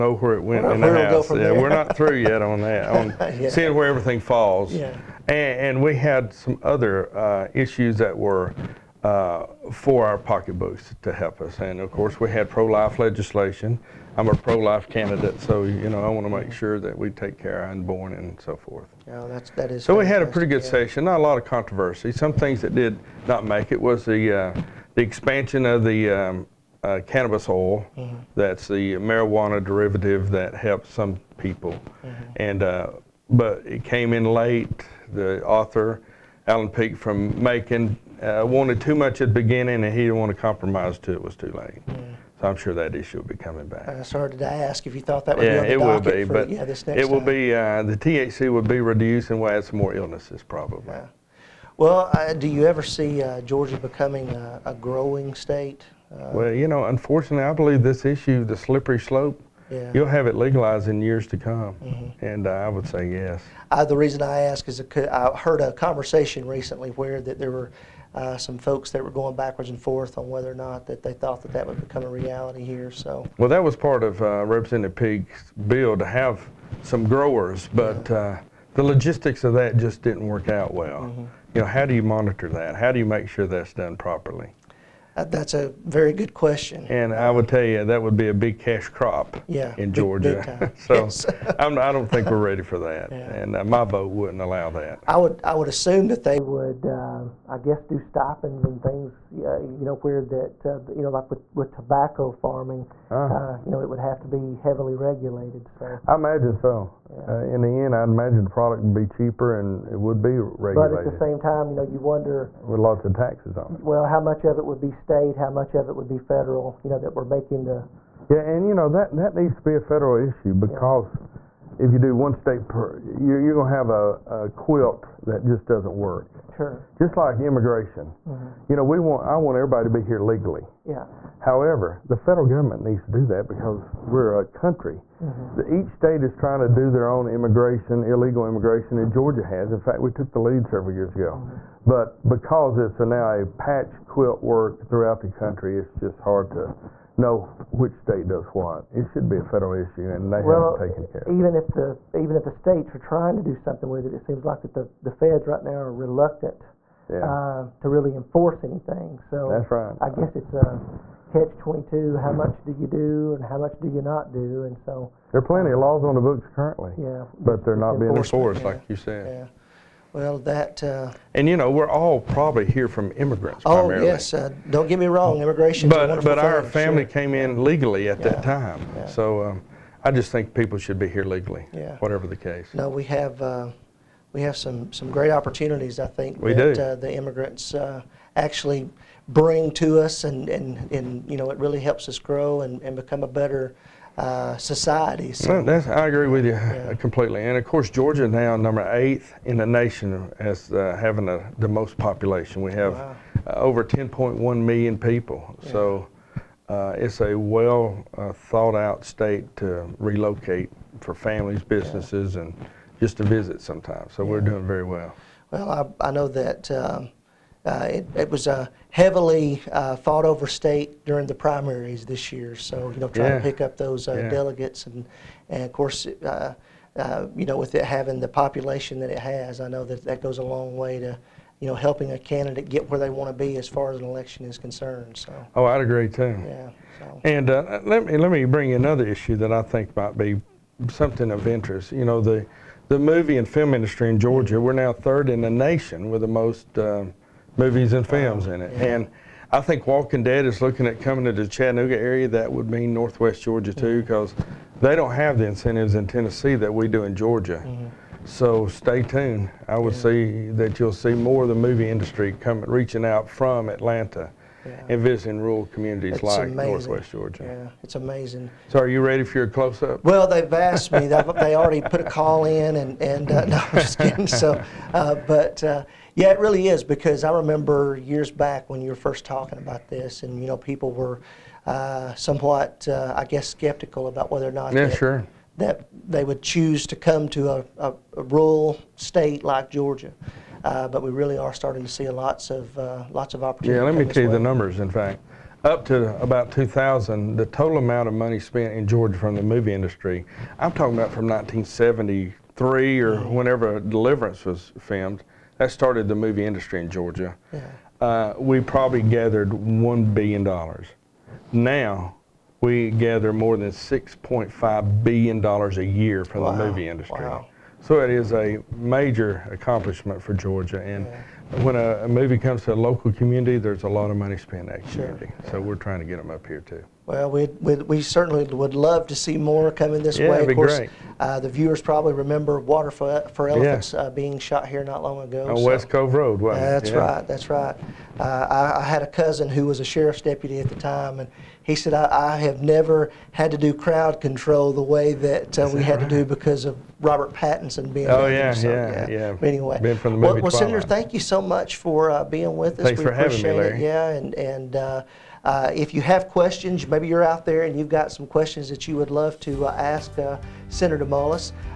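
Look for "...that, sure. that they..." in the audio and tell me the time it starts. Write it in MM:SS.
04:44.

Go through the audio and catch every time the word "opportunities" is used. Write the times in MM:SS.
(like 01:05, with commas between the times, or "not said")
03:05, 04:53.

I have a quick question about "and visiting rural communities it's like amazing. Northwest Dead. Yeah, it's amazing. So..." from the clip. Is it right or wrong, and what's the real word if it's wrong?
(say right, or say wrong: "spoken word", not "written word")
wrong: "Georgia", not "Dead".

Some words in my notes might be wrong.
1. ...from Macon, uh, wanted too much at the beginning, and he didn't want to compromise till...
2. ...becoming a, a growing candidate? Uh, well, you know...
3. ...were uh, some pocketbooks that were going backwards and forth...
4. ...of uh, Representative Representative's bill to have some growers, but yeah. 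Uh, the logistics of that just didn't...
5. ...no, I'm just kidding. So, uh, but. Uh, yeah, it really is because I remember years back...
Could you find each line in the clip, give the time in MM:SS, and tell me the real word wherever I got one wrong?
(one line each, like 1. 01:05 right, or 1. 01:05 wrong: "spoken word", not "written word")
1. 00:36 right
2. 00:53 wrong: "state", not "candidate"
3. 01:07 wrong: "folks", not "pocketbooks"
4. 01:14 wrong: "Peake", not "Representative"
5. 04:33 right.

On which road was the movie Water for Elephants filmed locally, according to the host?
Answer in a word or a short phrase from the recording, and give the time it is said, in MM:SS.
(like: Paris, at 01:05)
West Cove Road, at 05:35.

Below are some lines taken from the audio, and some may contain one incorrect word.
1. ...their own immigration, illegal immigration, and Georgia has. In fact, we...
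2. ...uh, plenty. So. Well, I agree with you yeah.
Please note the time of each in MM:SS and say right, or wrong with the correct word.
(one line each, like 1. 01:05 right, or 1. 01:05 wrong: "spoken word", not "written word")
1. 02:16 right
2. 03:14 wrong: "society", not "plenty".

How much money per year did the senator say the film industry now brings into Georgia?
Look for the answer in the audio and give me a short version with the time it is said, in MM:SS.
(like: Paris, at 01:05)
$6.5 billion, at 05:13.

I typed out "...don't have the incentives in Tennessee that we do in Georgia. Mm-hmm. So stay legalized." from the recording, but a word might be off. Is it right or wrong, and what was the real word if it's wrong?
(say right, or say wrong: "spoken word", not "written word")
wrong: "tuned", not "legalized".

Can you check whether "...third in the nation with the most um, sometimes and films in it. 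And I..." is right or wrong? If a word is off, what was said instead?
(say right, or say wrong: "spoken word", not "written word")
wrong: "movies", not "sometimes".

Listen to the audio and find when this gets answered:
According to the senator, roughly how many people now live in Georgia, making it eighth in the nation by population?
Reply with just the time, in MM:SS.
03:23.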